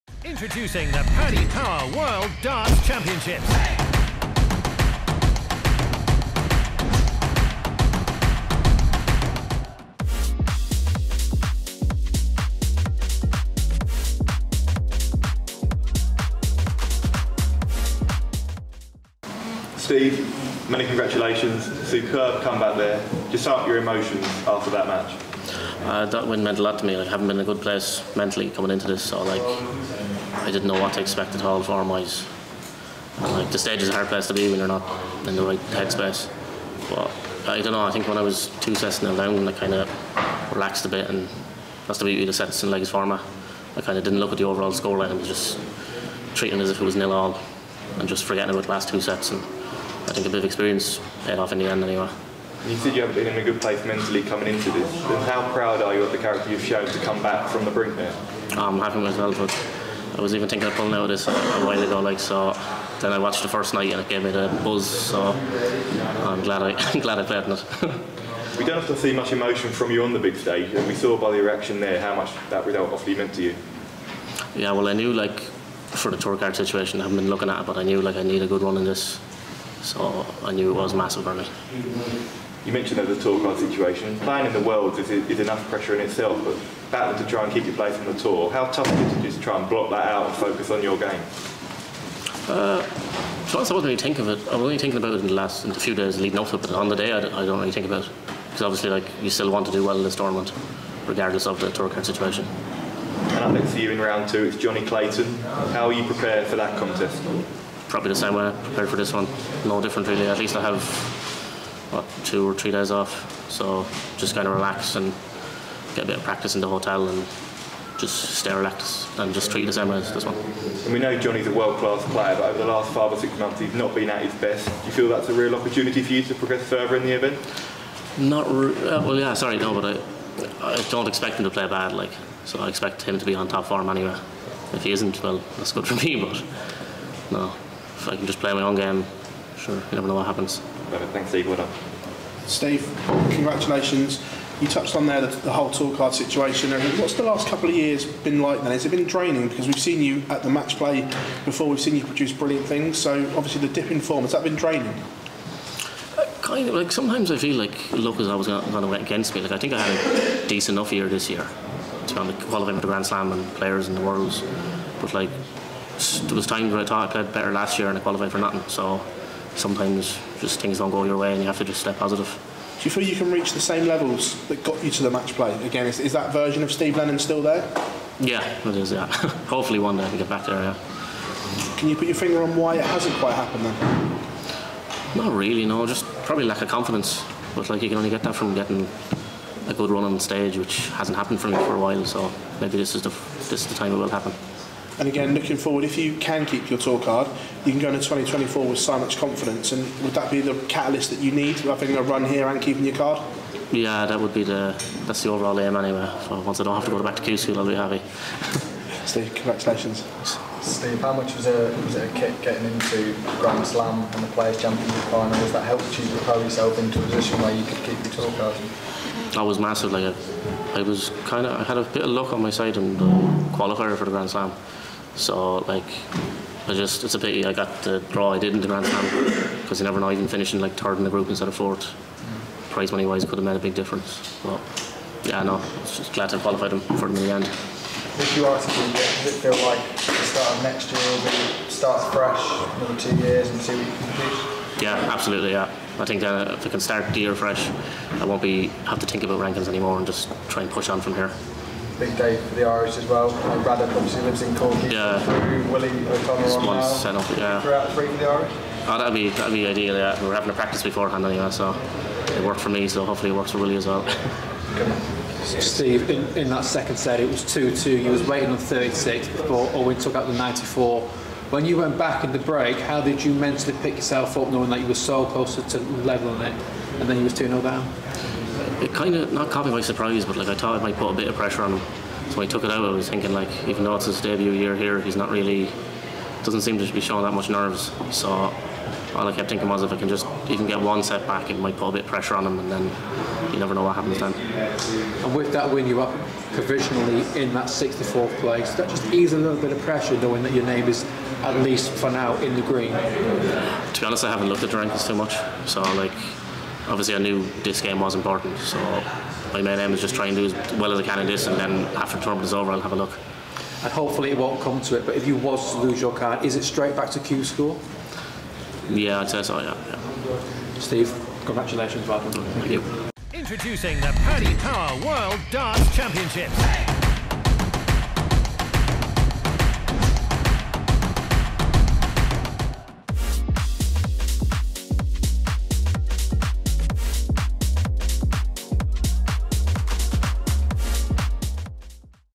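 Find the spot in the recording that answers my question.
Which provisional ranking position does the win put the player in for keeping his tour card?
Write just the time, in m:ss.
4:57.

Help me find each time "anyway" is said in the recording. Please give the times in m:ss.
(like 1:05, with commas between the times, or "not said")
0:51, 2:13, 3:25, 4:21.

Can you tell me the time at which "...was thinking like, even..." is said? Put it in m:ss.
4:42.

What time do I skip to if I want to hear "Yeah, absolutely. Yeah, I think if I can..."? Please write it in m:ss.
4:04.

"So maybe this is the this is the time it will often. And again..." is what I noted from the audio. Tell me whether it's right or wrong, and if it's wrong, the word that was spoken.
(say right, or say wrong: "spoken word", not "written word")
wrong: "happen", not "often".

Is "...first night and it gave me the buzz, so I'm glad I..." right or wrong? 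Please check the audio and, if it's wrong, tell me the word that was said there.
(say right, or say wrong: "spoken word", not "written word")
right.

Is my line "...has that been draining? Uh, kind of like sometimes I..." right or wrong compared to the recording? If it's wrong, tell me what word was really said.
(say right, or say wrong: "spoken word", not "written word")
right.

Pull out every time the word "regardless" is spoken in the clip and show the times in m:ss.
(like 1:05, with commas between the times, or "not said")
1:41.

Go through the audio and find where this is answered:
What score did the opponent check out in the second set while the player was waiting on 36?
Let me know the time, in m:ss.
4:30.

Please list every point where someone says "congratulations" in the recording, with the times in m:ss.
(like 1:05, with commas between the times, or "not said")
0:20, 2:23, 3:29, 5:21.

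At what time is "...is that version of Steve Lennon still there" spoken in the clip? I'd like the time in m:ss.
2:55.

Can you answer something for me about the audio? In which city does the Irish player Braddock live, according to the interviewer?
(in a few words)
Cork.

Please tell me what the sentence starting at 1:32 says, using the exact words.
Uh, I wasn't really thinking of it.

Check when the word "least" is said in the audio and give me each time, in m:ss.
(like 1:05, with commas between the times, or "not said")
1:50, 5:01.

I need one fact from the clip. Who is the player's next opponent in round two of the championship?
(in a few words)
Johnny Clayton.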